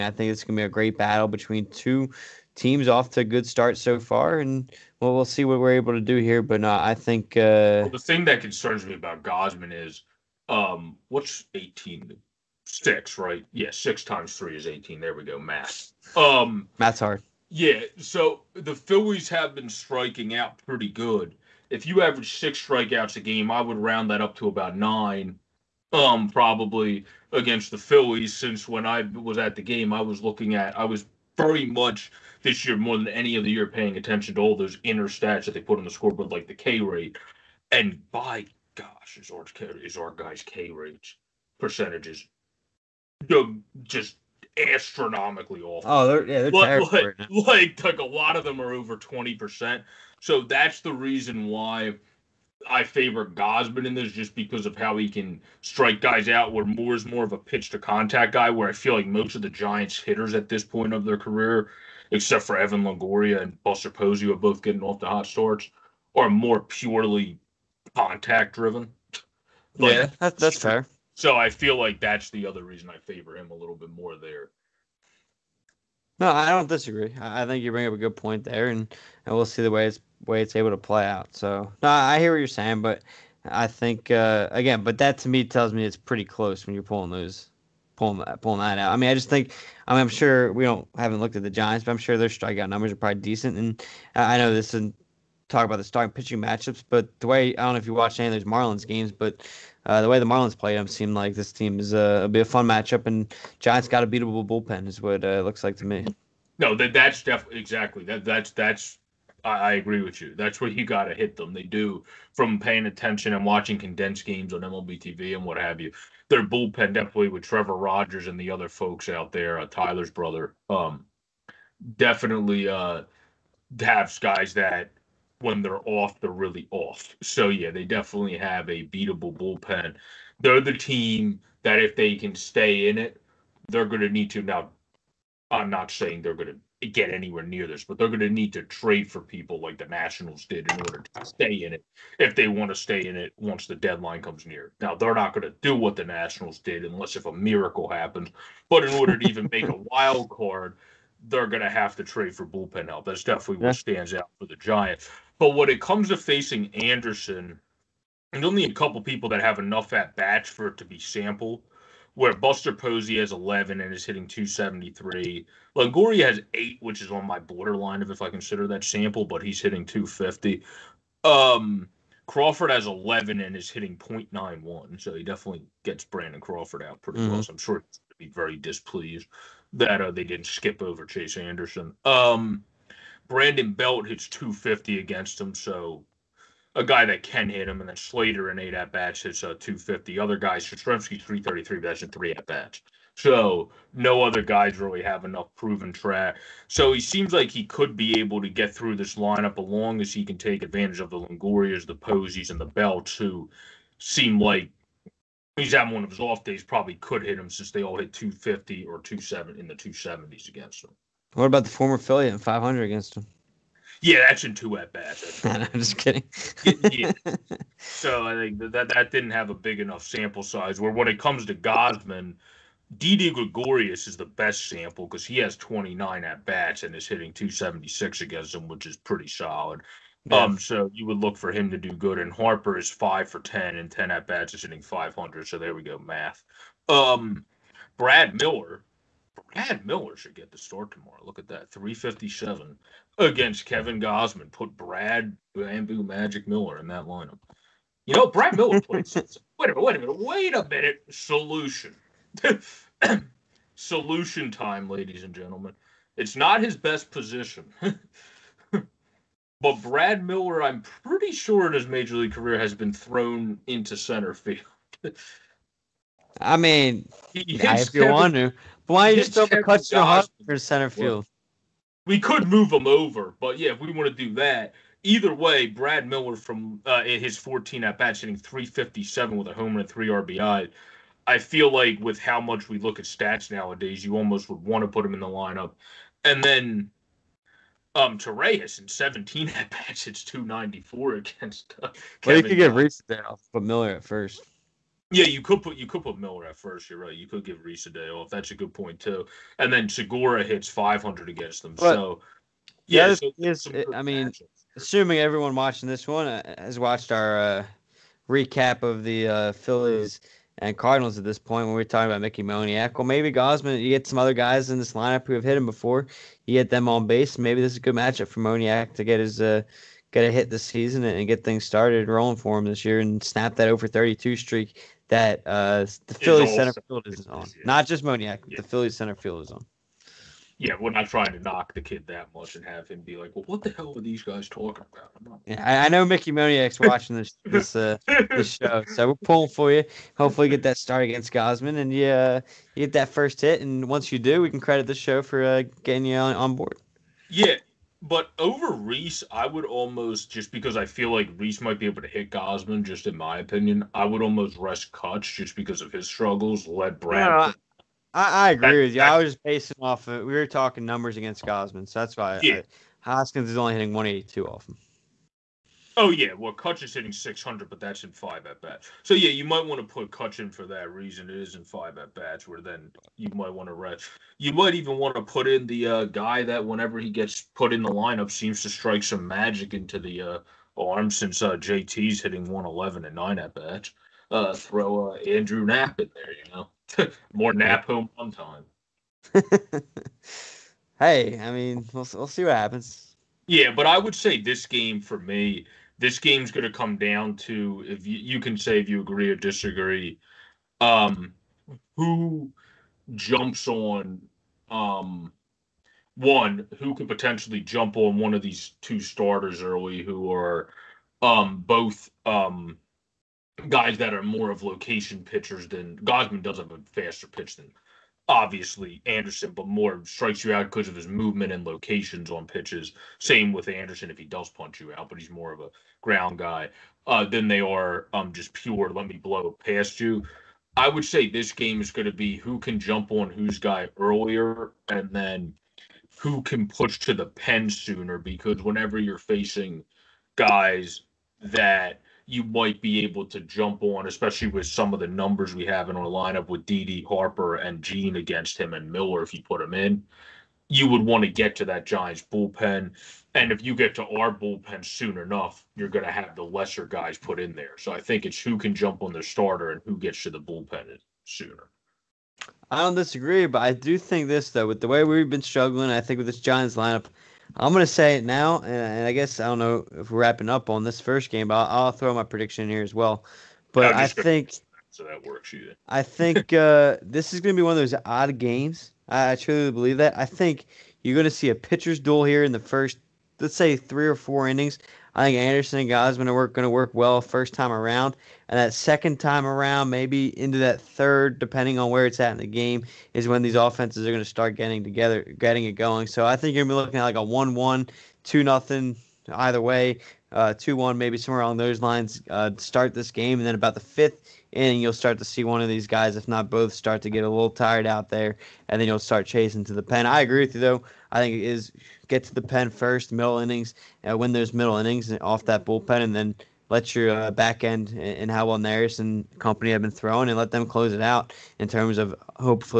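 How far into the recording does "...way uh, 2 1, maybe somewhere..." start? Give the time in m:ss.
8:19.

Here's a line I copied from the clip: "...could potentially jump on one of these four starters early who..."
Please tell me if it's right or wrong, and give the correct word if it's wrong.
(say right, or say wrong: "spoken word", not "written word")
wrong: "two", not "four".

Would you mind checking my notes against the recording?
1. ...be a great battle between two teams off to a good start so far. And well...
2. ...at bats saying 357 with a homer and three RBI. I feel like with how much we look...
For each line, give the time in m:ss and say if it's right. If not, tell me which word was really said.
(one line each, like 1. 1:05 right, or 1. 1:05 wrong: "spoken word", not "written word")
1. 0:00 right
2. 4:37 wrong: "hitting", not "saying".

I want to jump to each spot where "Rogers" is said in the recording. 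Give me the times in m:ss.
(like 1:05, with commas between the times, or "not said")
1:57.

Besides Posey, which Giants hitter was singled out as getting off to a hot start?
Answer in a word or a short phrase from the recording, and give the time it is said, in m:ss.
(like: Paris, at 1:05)
Evan Longoria, at 1:02.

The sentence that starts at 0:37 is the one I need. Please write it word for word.
And by gosh, is our guy's K rates percentages just astronomically awful.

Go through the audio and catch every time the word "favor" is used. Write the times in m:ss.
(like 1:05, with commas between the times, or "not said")
0:52, 1:12.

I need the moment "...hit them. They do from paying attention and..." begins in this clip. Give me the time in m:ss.
1:51.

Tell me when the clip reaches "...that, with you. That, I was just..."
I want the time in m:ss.
5:58.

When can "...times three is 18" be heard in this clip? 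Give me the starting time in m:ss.
0:14.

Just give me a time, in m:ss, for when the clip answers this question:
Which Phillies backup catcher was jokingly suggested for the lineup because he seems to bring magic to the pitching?
6:25.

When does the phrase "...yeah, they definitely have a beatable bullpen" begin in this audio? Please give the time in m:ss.
2:07.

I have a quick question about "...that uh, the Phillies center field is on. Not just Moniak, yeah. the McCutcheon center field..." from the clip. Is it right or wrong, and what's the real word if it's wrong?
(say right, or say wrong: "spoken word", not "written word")
wrong: "Phillies", not "McCutcheon".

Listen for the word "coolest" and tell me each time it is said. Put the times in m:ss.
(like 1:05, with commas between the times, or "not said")
not said.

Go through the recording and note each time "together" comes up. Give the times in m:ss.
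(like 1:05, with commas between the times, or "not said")
8:14.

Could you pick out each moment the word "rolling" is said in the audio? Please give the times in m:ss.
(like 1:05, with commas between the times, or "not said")
5:22.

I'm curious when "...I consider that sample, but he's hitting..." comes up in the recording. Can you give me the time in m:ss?
2:48.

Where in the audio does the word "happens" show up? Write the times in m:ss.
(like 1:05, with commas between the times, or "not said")
2:27, 6:32.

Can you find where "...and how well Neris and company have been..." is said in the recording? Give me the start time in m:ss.
8:37.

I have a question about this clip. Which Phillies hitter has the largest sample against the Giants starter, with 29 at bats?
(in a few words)
Didi Gregorius.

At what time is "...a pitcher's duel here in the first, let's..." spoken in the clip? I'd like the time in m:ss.
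8:01.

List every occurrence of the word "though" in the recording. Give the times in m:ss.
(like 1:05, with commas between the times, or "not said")
7:44, 8:30.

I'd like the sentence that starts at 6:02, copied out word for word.
I, Hoskins is only hitting 182 off him.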